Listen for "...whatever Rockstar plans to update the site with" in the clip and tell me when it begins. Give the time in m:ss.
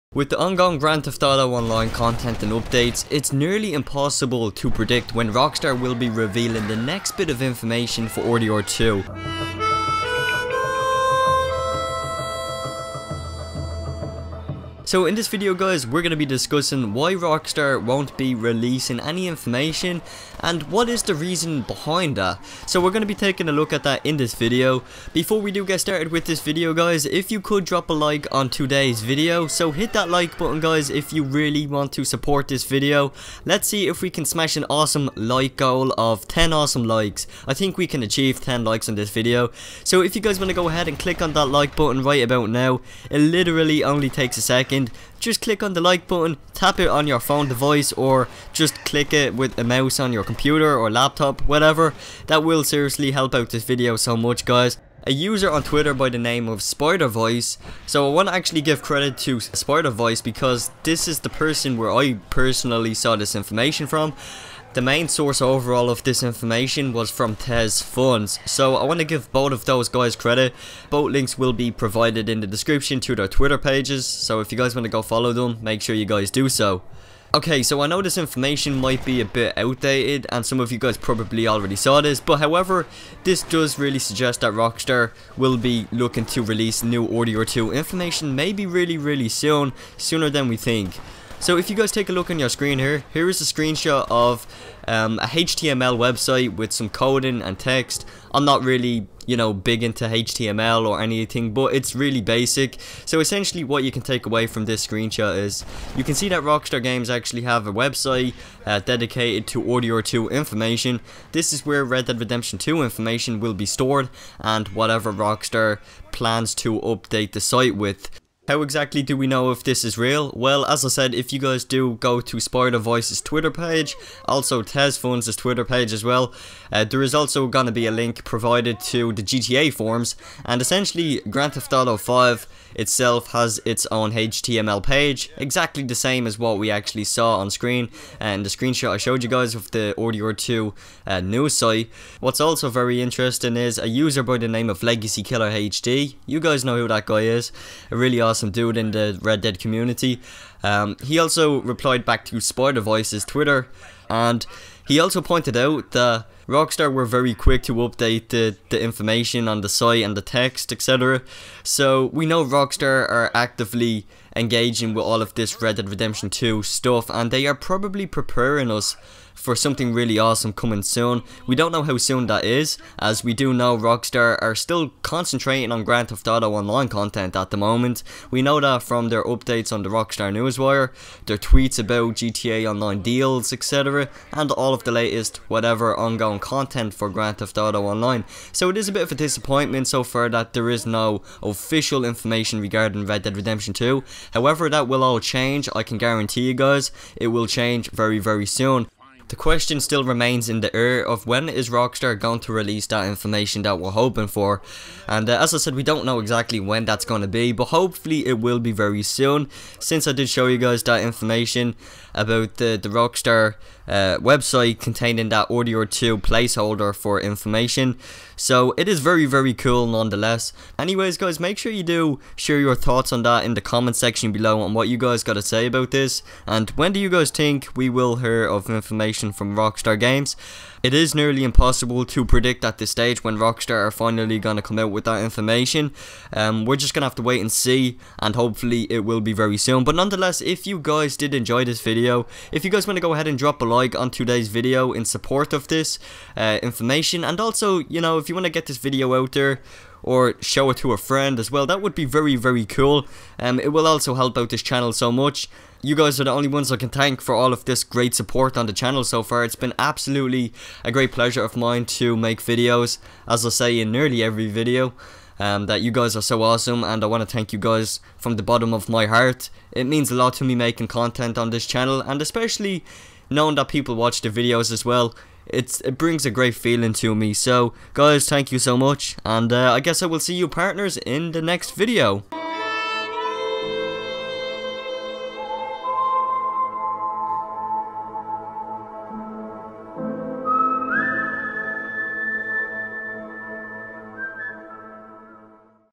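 1:54.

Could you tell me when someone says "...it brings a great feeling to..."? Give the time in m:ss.
4:35.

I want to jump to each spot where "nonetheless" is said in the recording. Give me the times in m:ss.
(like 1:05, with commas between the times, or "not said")
3:39, 3:59.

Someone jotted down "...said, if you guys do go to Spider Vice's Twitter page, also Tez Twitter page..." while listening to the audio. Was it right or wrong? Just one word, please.
right.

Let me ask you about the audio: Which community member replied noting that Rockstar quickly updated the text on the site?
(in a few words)
LegacyKillaHD.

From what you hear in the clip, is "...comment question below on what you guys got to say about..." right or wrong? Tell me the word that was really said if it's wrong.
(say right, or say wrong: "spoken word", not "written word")
wrong: "section", not "question".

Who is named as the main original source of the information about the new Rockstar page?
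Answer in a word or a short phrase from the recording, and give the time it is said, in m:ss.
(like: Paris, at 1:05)
TezFunz, at 1:07.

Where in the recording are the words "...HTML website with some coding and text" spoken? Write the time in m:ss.
1:35.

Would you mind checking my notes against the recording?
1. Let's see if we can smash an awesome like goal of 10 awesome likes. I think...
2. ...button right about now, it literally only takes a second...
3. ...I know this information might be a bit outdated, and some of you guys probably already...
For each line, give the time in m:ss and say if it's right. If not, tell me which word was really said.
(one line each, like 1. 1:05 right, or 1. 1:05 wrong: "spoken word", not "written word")
1. 0:33 right
2. 0:41 right
3. 1:17 right.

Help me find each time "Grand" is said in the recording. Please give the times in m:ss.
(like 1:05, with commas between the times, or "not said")
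0:00, 2:11, 2:55, 3:07.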